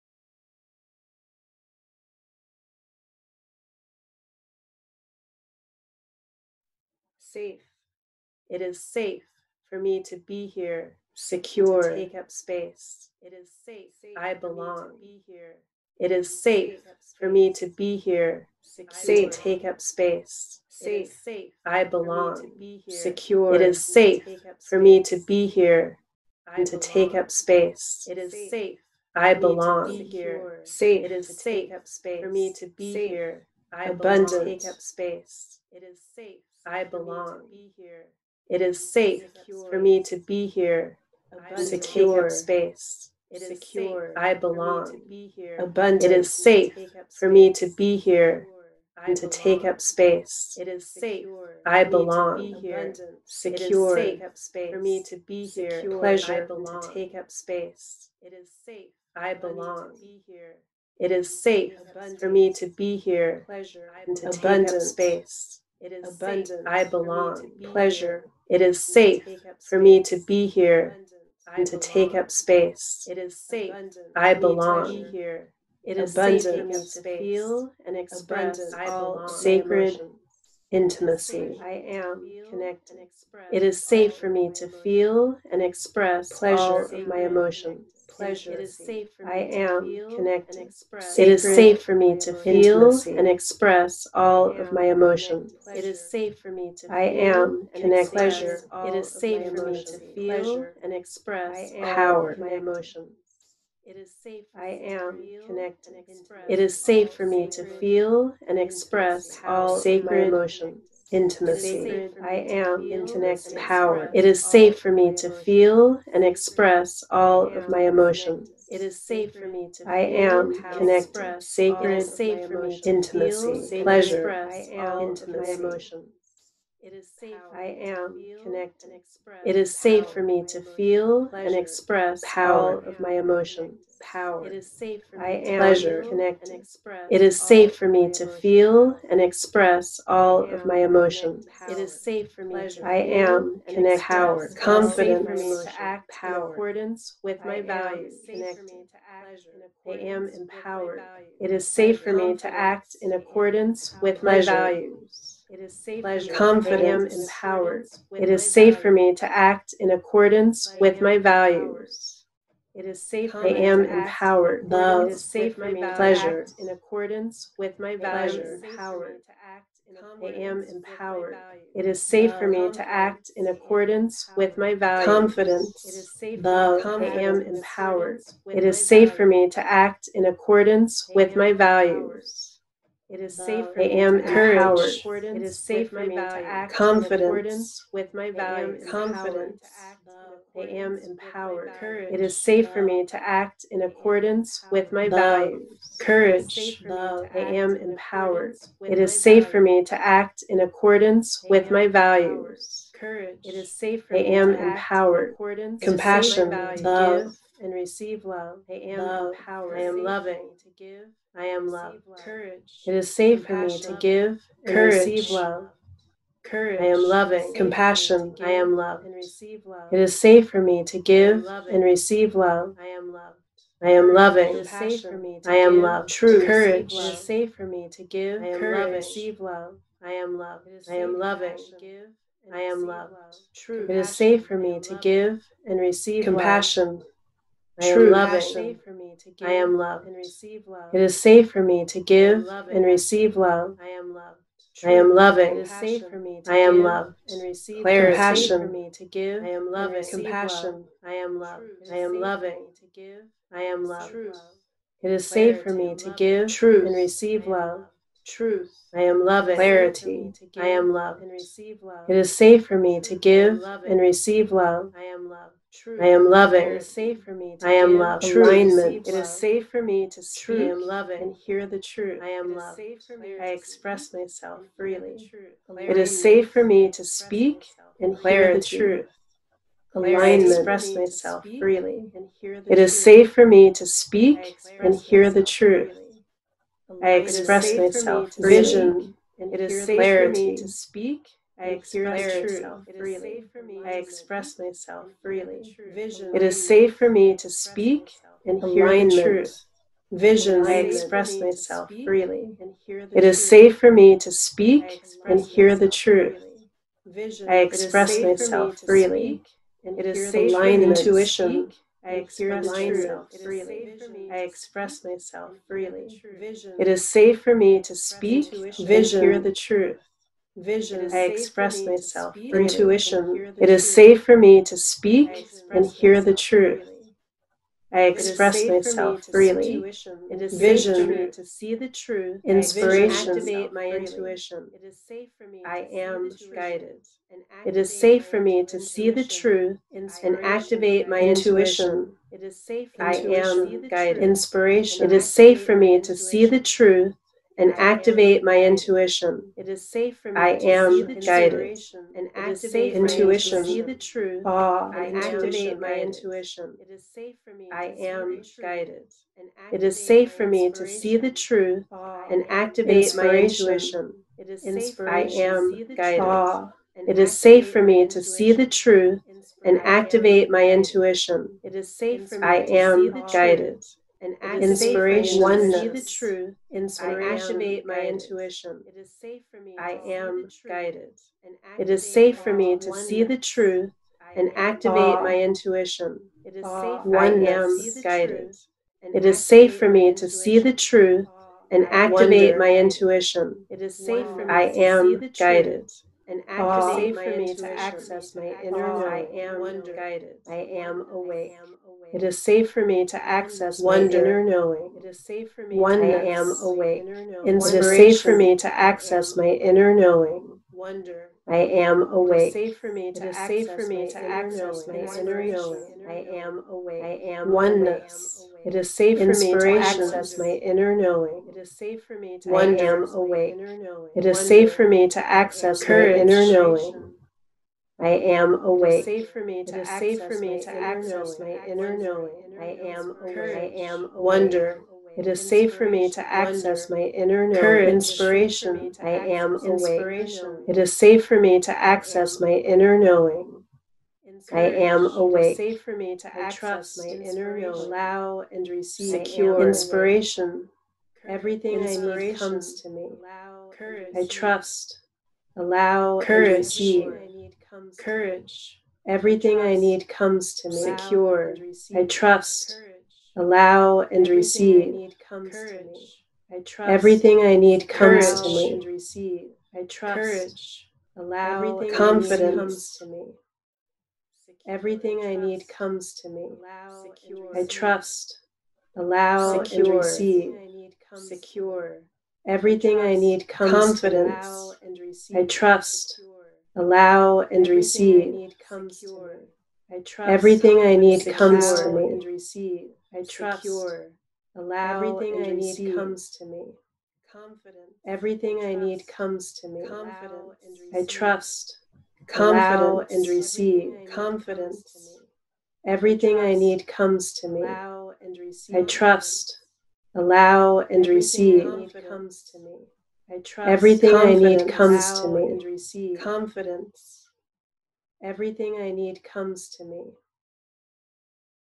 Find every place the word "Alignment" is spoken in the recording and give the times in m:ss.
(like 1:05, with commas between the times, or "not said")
4:28, 4:39.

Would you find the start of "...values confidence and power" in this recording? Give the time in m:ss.
2:34.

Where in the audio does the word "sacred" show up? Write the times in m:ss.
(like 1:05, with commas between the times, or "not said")
1:19, 1:49, 2:01.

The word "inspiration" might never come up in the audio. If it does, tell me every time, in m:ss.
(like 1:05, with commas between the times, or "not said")
5:32, 5:44, 7:17, 7:29.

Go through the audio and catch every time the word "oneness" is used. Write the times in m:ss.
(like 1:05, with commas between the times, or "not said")
6:15, 6:57.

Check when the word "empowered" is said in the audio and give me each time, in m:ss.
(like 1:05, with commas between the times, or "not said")
2:30, 2:43, 2:50, 2:57, 3:10, 3:17, 3:24, 3:29.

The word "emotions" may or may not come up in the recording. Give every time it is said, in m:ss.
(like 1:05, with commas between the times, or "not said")
1:27, 1:34, 1:42, 1:50, 1:57, 2:05, 2:13, 2:20.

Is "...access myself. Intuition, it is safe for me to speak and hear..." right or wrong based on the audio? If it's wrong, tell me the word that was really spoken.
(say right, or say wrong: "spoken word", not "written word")
wrong: "express", not "access".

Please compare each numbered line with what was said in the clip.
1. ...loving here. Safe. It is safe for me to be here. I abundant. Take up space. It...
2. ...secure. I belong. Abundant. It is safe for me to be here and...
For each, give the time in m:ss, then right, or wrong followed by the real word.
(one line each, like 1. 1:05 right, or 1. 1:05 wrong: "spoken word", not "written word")
1. 0:29 wrong: "belong", not "loving"
2. 0:43 right.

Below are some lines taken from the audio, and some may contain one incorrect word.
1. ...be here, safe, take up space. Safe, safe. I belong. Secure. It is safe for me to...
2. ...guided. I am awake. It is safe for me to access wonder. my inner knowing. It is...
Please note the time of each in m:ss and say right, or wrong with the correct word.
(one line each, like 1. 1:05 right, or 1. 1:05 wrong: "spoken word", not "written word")
1. 0:17 right
2. 6:39 right.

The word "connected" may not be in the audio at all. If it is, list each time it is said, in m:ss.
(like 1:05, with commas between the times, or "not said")
1:22, 1:30, 1:37, 1:45, 2:00, 2:08, 2:16, 2:23.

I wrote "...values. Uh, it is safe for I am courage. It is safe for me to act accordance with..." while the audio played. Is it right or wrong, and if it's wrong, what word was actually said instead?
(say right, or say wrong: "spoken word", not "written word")
wrong: "confidence", not "accordance".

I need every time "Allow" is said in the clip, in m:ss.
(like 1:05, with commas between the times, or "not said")
7:27, 7:35, 7:43, 7:51, 7:58, 8:06, 8:14, 8:30.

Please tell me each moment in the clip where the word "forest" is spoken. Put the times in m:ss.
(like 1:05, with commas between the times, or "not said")
not said.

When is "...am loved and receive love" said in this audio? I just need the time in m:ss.
3:59.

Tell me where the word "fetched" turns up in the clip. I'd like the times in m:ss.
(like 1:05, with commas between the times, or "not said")
not said.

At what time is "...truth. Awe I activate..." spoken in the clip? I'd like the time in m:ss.
5:53.